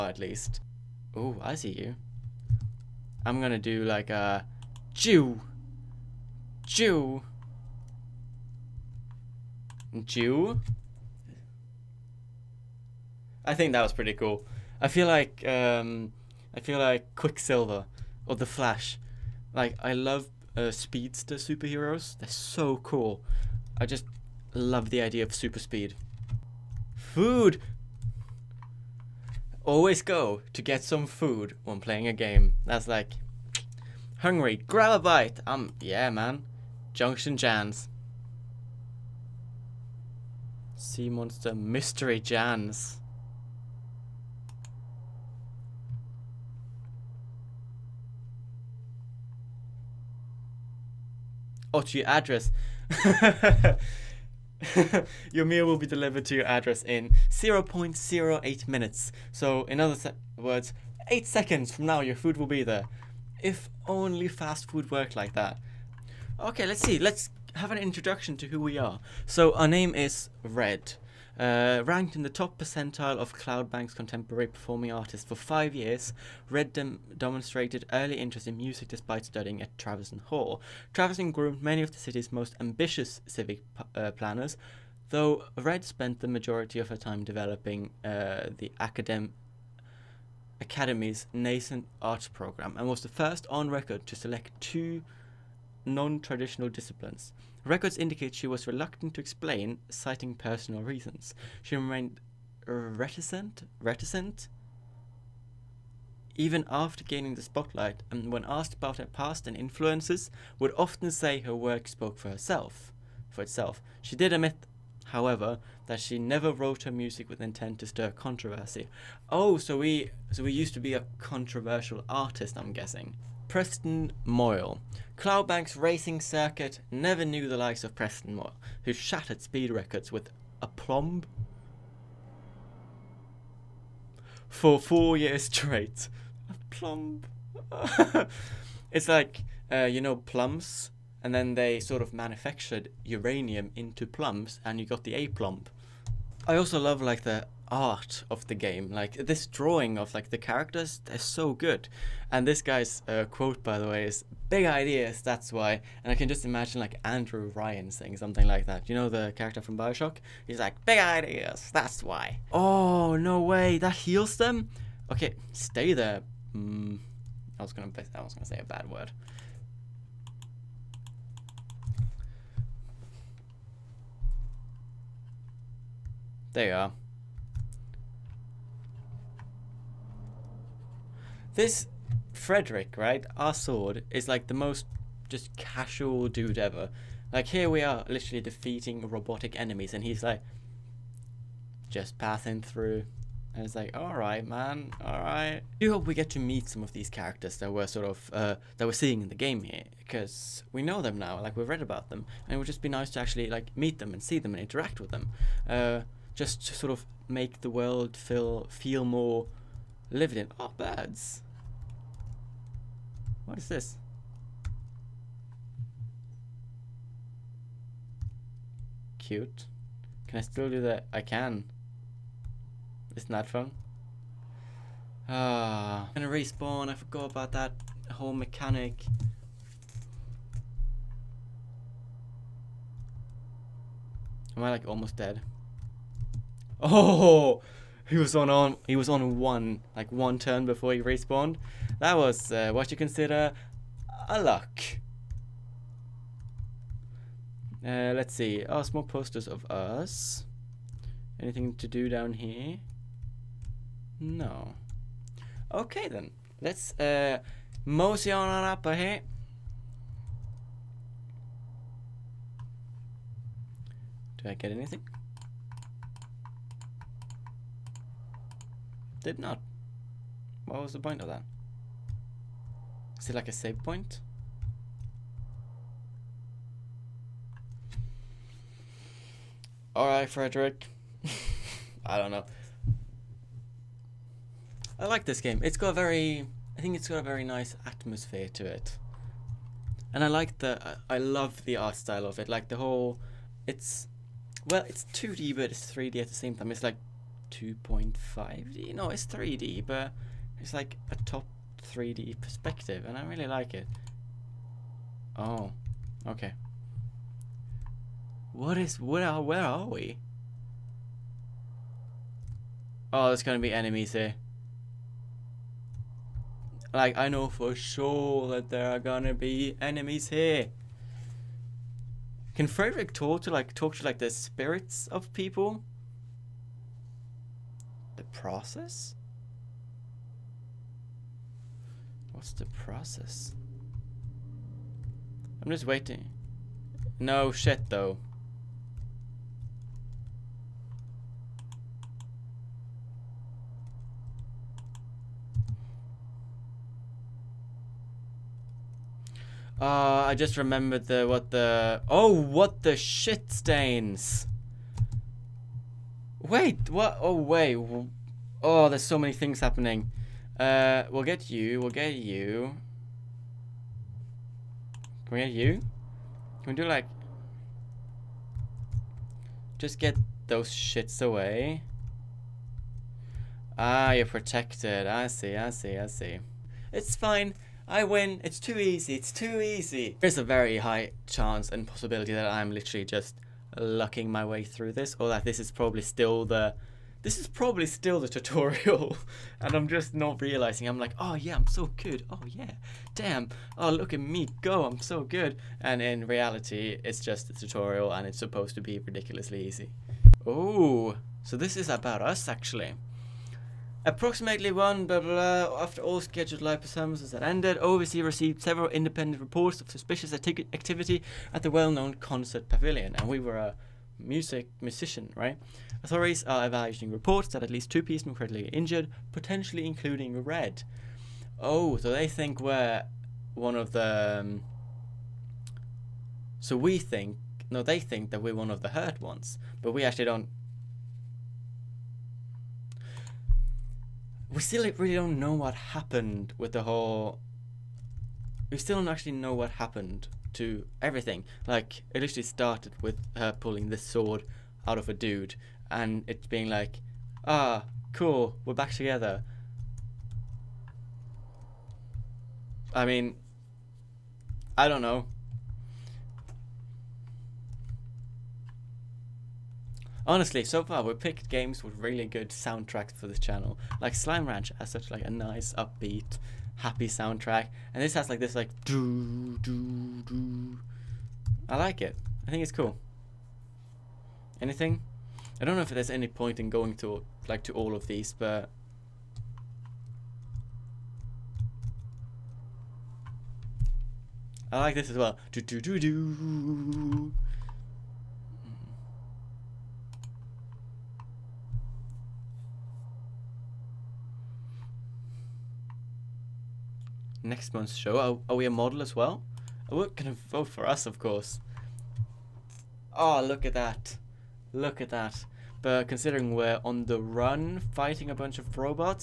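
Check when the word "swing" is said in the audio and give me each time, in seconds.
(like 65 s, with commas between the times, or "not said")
not said.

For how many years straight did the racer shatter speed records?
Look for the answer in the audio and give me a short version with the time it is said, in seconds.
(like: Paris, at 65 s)
4, at 134 s.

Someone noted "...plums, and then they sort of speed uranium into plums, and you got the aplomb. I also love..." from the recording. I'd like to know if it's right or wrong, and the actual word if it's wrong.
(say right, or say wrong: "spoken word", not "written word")
wrong: "manufactured", not "speed".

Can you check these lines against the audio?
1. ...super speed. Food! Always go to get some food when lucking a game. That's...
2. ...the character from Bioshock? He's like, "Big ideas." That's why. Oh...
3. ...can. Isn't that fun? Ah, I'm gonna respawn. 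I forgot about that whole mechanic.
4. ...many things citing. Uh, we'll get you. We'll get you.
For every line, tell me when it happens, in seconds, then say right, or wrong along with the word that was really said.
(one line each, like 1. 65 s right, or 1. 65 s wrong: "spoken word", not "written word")
1. 25 s wrong: "playing", not "lucking"
2. 159 s right
3. 221 s right
4. 359 s wrong: "happening", not "citing".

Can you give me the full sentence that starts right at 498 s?
Are, are we a model as well?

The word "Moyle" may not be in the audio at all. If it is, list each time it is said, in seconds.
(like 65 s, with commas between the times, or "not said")
124 s, 128 s.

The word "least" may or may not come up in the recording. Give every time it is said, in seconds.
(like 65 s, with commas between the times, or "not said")
0 s, 417 s.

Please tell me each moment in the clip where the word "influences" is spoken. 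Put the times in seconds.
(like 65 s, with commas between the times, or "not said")
109 s.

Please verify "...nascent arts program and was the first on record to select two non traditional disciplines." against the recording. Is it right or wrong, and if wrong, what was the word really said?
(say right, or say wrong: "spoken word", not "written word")
right.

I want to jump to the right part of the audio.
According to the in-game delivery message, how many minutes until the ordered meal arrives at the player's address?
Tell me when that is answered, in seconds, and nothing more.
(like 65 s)
57 s.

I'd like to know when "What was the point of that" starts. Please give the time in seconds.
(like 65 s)
270 s.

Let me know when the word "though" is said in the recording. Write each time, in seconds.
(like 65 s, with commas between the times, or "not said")
85 s, 337 s.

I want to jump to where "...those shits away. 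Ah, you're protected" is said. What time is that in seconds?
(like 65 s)
370 s.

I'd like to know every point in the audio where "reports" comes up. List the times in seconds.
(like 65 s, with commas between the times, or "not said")
409 s, 417 s.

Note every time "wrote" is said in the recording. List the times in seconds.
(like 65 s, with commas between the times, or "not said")
116 s.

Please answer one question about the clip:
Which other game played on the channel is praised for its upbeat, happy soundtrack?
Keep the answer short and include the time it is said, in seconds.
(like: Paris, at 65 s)
Slime Ranch, at 464 s.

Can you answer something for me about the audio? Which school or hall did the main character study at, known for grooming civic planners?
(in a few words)
Traverson Hall.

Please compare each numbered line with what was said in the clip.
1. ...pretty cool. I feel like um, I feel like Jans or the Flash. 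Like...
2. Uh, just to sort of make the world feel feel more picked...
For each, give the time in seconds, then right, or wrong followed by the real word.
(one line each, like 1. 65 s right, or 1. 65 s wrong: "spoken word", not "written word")
1. 13 s wrong: "Quicksilver", not "Jans"
2. 205 s wrong: "lived", not "picked".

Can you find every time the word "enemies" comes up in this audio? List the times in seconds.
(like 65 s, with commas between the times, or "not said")
189 s, 313 s, 319 s.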